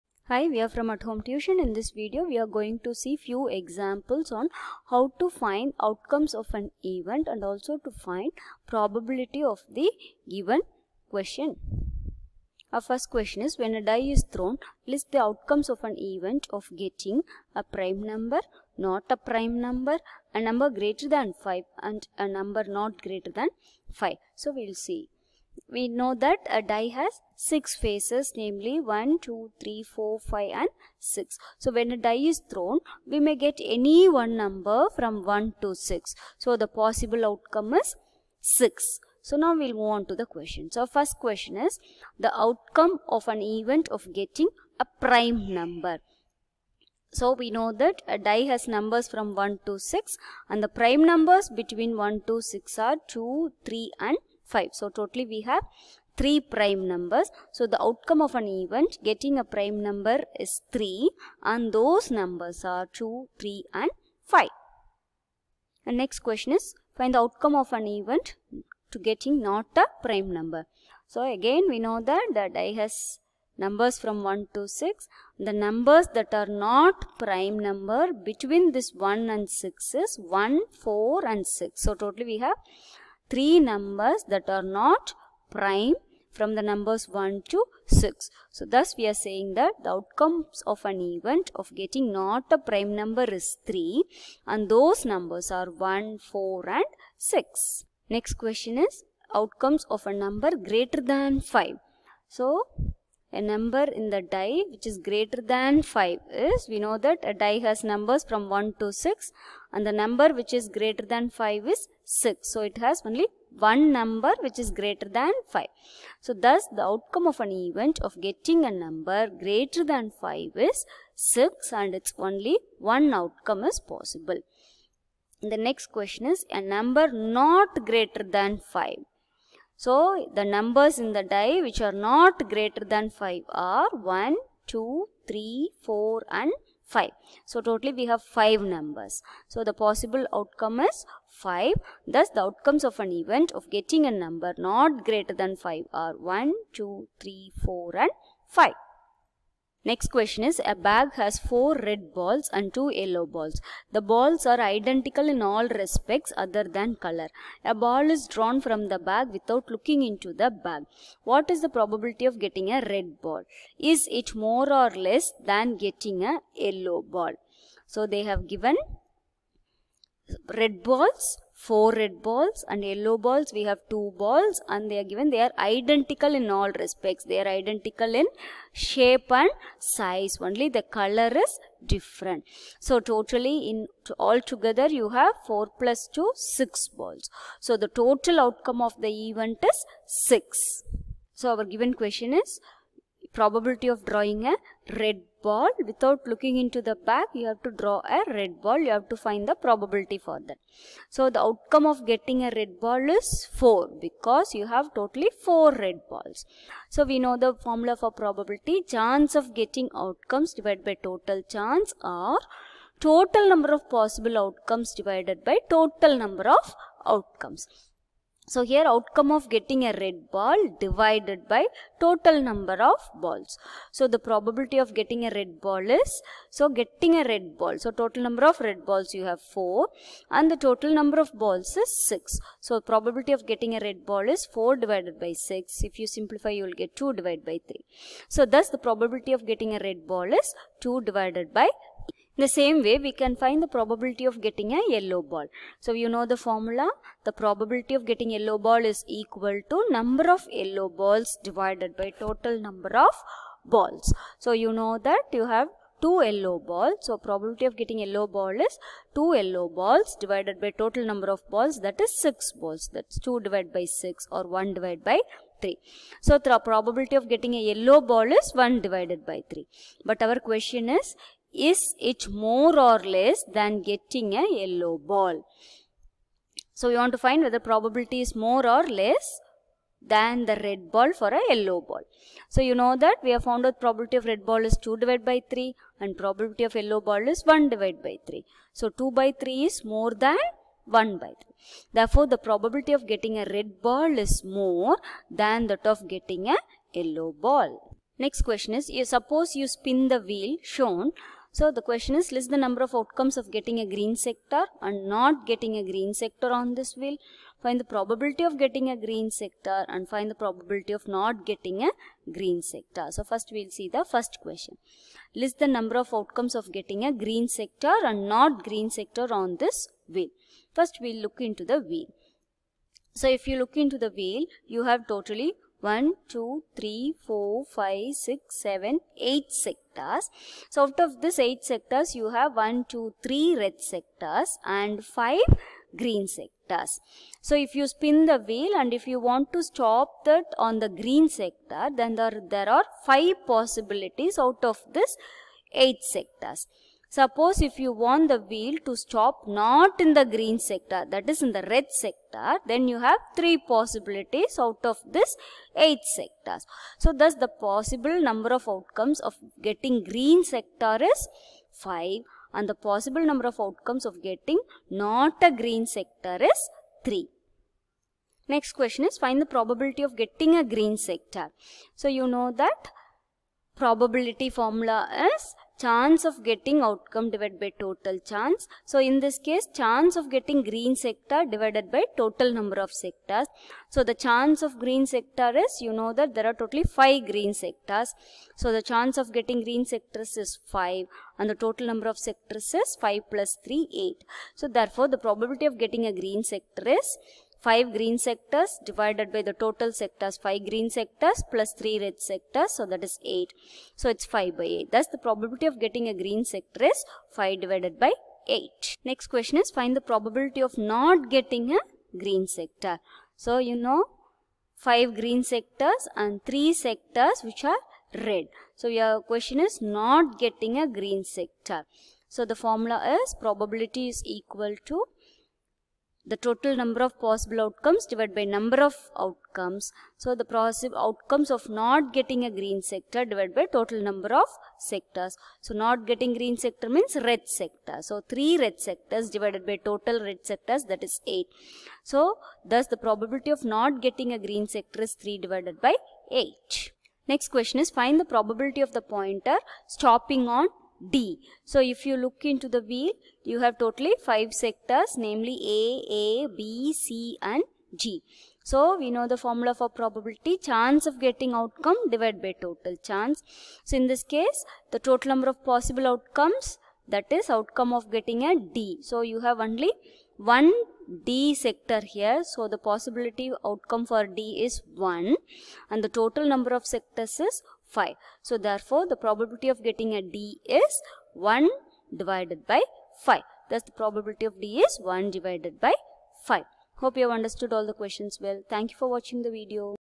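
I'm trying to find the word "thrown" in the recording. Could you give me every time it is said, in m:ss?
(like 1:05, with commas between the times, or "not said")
0:14, 0:32.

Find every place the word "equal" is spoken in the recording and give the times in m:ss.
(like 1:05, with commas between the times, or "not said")
4:09, 7:04.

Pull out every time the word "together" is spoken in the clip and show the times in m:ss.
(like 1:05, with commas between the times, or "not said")
3:04.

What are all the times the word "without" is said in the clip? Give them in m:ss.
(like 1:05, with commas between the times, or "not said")
2:39, 3:15.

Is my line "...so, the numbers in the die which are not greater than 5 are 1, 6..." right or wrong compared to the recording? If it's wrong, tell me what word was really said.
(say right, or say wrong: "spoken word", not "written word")
wrong: "2", not "6".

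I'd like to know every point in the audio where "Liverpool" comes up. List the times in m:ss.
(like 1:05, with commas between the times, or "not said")
not said.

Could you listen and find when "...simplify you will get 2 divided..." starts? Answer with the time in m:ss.
3:56.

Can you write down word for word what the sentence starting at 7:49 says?
So you have only one D sector here.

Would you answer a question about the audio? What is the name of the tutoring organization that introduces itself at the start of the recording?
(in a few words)
At Home Tuition.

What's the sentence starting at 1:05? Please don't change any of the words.
And next question is find the outcome of an event to getting not a prime number.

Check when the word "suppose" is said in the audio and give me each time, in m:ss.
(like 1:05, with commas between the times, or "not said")
4:59, 5:47.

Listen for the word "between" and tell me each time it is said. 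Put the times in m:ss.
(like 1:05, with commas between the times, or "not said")
0:51, 1:18.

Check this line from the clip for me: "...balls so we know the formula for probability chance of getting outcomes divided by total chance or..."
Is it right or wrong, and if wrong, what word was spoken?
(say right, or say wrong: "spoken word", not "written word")
right.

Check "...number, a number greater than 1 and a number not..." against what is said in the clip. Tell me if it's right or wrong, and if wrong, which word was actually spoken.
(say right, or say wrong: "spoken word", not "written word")
wrong: "5", not "1".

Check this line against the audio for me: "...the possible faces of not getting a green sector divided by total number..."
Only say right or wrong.
wrong.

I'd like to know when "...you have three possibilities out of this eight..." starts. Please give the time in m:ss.
5:52.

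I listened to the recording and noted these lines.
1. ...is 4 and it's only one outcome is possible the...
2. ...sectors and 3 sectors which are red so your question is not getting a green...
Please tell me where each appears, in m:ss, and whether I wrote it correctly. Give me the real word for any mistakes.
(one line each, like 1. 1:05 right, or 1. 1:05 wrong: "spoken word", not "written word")
1. 2:00 wrong: "6", not "4"
2. 6:55 right.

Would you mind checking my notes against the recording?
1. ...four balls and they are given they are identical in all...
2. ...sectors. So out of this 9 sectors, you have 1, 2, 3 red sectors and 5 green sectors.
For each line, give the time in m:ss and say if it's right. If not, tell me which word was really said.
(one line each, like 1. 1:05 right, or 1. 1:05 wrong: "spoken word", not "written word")
1. 2:53 wrong: "two", not "four"
2. 5:29 wrong: "8", not "9".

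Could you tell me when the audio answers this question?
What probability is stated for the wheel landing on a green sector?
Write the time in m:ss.
6:44.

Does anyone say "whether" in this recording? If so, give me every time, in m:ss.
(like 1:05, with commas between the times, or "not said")
4:37.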